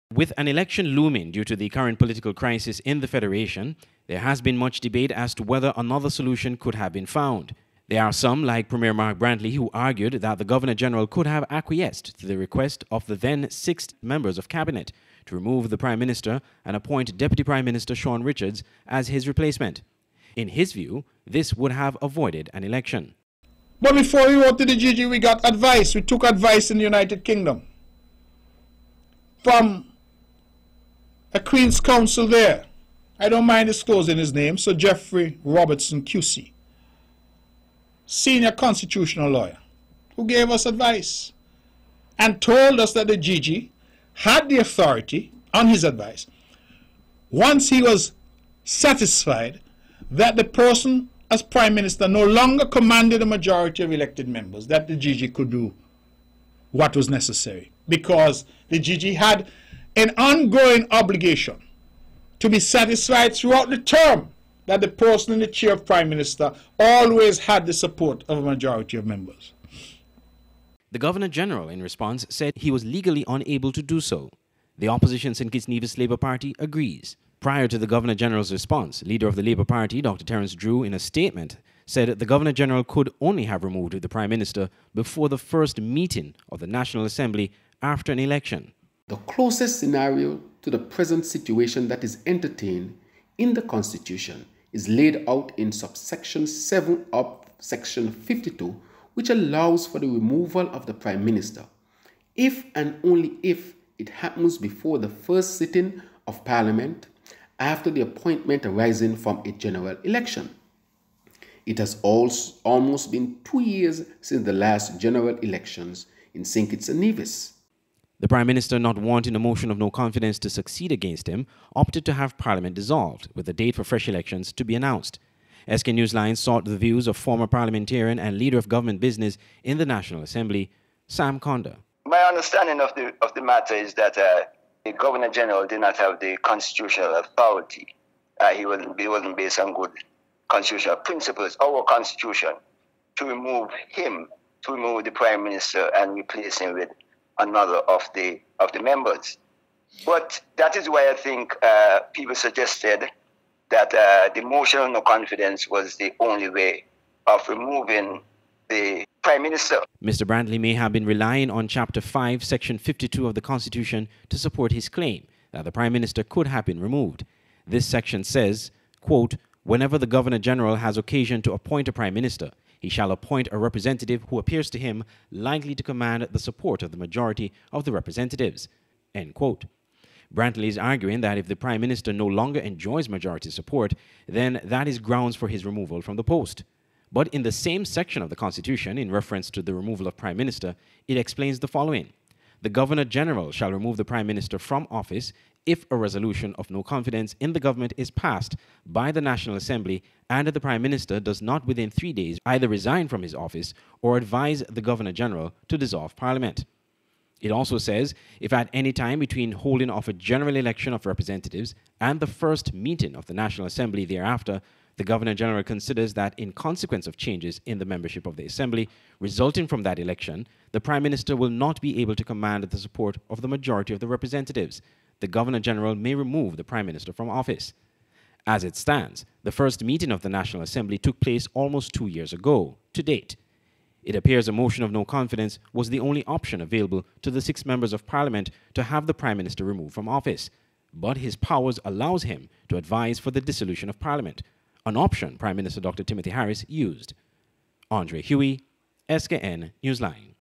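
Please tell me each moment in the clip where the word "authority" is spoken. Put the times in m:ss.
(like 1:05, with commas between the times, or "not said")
0:44, 2:17.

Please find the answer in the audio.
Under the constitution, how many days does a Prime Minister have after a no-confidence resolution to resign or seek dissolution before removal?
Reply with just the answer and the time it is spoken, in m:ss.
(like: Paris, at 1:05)
3 days, at 3:21.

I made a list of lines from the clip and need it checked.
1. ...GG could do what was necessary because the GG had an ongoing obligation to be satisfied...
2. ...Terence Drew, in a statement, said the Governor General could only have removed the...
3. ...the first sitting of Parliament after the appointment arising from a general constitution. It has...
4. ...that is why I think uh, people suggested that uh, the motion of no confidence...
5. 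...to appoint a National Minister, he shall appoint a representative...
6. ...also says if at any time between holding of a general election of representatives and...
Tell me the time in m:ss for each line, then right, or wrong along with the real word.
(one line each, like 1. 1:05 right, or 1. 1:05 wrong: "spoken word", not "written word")
1. 0:54 right
2. 1:20 right
3. 1:44 wrong: "election", not "constitution"
4. 2:30 right
5. 2:51 wrong: "Prime", not "National"
6. 3:27 right.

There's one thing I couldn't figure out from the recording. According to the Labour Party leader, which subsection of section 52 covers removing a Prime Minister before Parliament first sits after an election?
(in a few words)
subsection 7.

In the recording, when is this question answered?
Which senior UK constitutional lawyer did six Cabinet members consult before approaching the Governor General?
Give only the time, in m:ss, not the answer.
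0:34.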